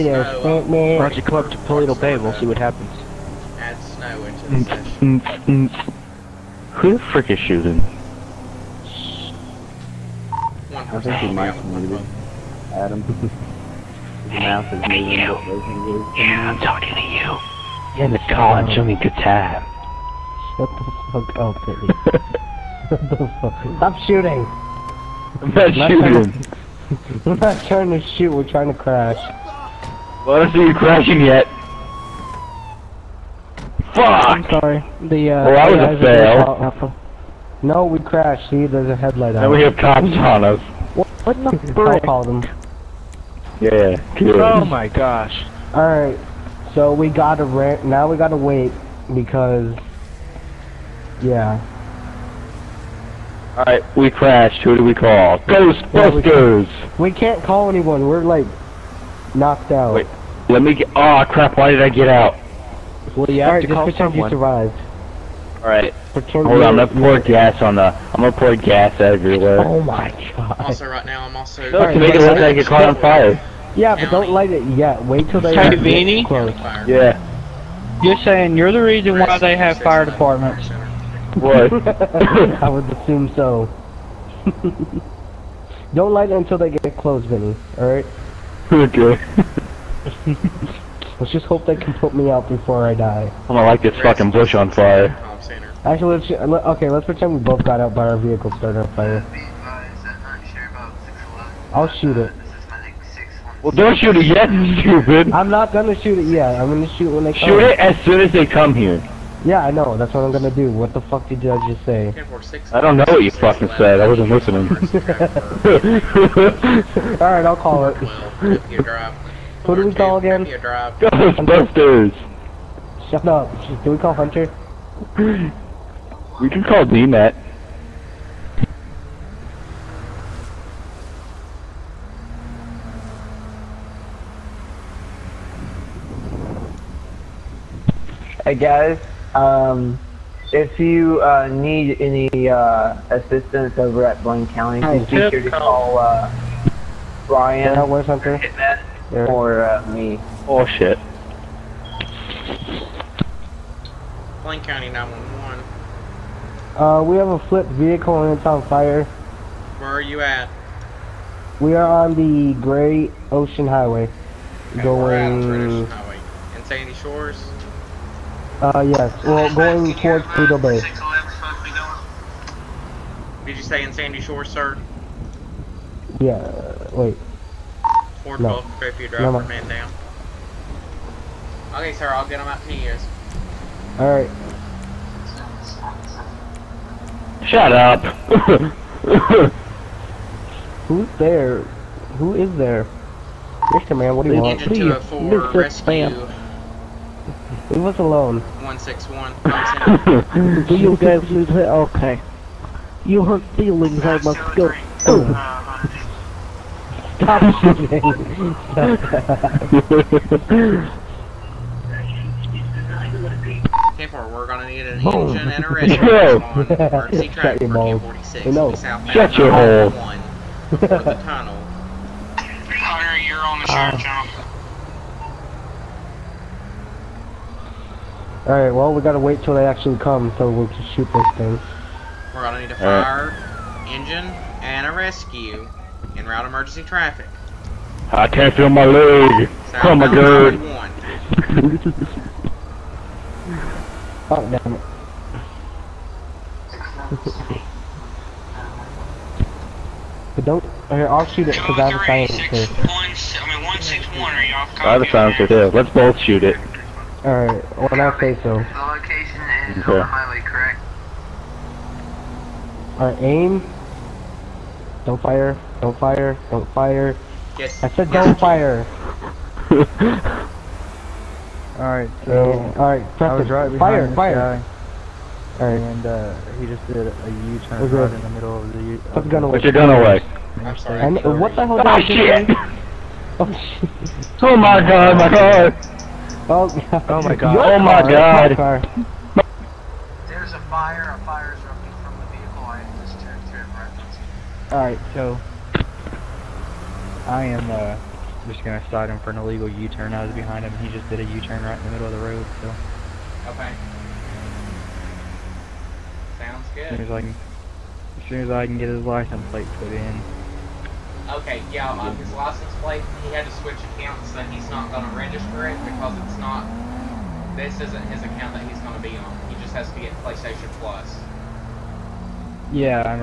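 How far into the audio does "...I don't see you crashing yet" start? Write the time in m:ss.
0:30.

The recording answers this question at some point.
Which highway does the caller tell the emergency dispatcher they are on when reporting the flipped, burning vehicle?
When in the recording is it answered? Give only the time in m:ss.
2:42.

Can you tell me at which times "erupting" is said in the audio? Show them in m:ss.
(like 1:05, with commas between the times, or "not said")
4:51.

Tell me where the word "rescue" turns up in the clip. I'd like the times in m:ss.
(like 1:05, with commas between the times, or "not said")
3:15, 3:54.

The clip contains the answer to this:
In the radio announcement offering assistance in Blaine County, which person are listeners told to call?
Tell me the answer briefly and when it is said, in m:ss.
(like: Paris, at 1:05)
Brian, at 2:27.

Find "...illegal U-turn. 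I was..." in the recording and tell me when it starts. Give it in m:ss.
4:59.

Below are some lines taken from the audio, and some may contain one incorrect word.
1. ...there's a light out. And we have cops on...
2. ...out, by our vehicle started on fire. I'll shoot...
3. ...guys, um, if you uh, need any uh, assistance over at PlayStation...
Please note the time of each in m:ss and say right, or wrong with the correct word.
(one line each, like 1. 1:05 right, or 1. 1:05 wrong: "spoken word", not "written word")
1. 0:38 wrong: "headlight", not "light"
2. 1:37 right
3. 2:18 wrong: "Blaine", not "PlayStation".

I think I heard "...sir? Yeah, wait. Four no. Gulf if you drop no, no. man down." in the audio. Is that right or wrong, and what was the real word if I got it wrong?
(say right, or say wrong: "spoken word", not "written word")
right.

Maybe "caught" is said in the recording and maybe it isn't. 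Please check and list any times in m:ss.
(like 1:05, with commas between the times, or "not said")
1:12.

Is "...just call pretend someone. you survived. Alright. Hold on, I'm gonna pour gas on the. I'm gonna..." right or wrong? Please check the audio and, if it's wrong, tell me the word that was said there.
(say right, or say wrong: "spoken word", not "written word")
right.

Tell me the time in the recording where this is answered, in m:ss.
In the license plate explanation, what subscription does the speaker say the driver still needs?
5:20.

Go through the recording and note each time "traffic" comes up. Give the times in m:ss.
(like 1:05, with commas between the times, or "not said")
3:37, 3:56.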